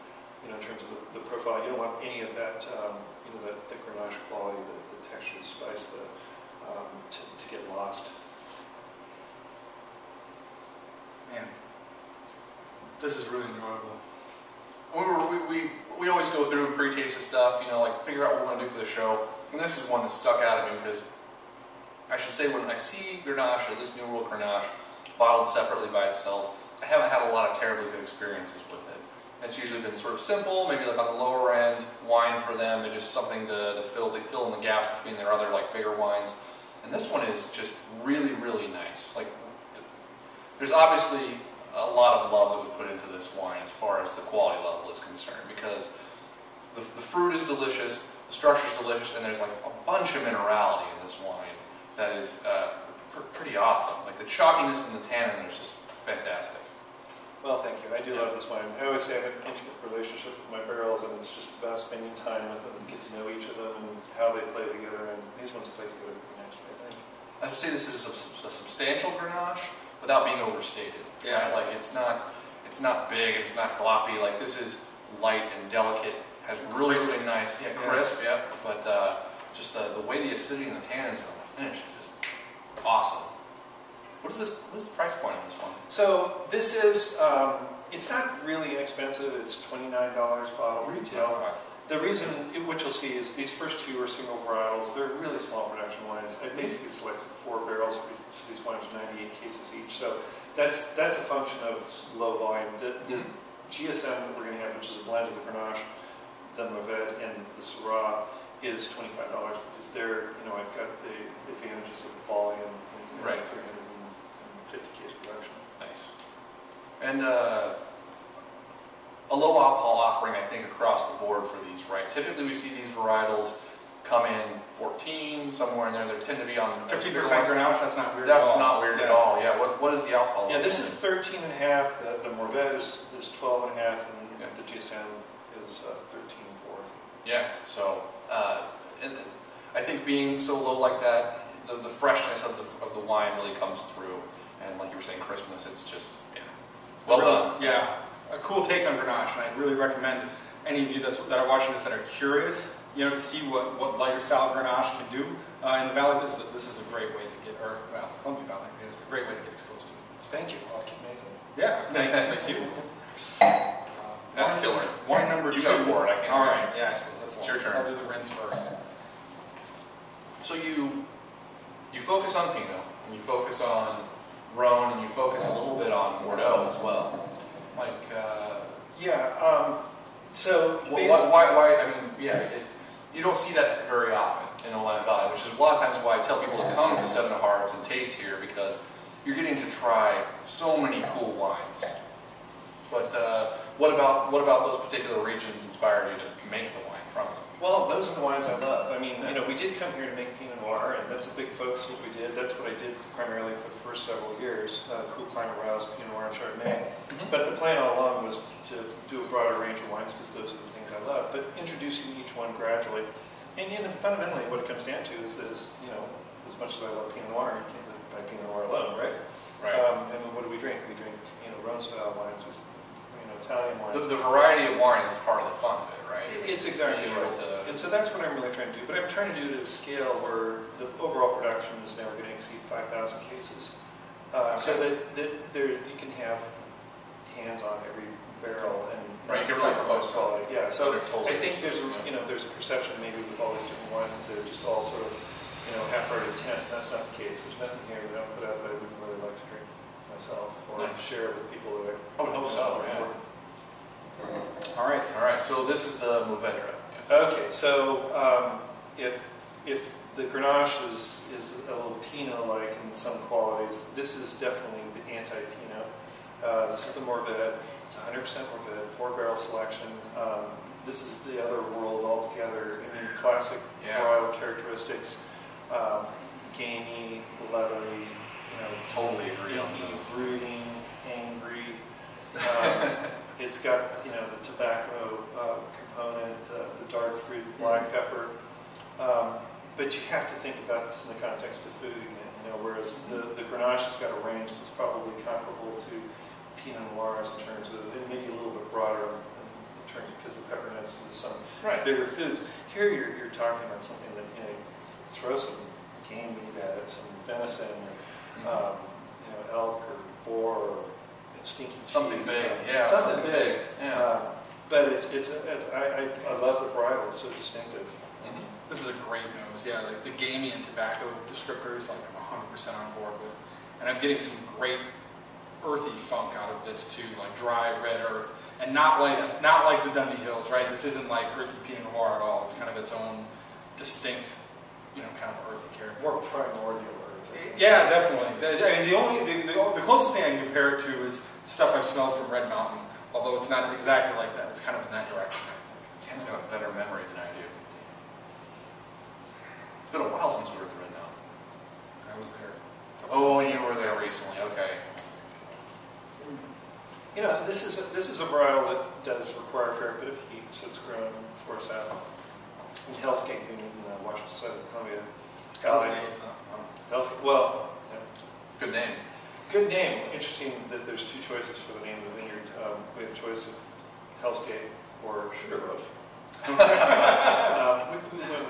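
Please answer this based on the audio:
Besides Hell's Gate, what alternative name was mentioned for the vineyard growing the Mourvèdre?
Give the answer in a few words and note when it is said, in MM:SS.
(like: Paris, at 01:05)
Sugarloaf, at 06:15.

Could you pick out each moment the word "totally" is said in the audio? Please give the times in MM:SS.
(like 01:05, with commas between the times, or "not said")
04:01, 04:38.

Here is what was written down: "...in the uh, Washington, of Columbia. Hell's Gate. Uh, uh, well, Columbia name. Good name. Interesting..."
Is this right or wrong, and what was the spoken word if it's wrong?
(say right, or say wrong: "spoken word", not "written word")
wrong: "Good", not "Columbia".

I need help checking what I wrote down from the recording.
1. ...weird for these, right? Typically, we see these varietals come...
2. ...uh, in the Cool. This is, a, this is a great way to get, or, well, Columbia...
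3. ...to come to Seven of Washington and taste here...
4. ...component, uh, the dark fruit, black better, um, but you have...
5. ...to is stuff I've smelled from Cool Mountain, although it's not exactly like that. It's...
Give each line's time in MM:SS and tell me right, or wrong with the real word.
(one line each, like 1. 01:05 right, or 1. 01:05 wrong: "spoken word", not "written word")
1. 02:01 wrong: "board", not "weird"
2. 02:35 wrong: "Valley", not "Cool"
3. 03:06 wrong: "Hearts", not "Washington"
4. 04:45 wrong: "pepper", not "better"
5. 05:40 wrong: "Red", not "Cool".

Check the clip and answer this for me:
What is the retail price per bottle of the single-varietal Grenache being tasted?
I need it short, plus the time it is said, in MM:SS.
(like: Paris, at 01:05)
$29, at 01:29.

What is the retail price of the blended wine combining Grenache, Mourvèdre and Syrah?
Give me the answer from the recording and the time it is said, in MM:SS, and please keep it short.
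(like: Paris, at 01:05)
$25, at 01:48.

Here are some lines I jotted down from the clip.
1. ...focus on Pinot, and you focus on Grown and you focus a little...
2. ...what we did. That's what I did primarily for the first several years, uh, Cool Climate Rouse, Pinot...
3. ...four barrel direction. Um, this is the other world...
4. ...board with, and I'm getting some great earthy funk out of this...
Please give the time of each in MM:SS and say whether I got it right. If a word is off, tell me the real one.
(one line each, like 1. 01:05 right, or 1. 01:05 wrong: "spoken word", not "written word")
1. 02:52 right
2. 03:21 right
3. 04:28 wrong: "selection", not "direction"
4. 05:22 right.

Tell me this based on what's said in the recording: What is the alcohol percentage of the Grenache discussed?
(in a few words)
13.5%.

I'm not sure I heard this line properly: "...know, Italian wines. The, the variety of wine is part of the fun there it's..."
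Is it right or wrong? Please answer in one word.
right.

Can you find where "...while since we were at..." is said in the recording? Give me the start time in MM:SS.
05:50.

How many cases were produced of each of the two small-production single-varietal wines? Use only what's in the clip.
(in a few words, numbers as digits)
98.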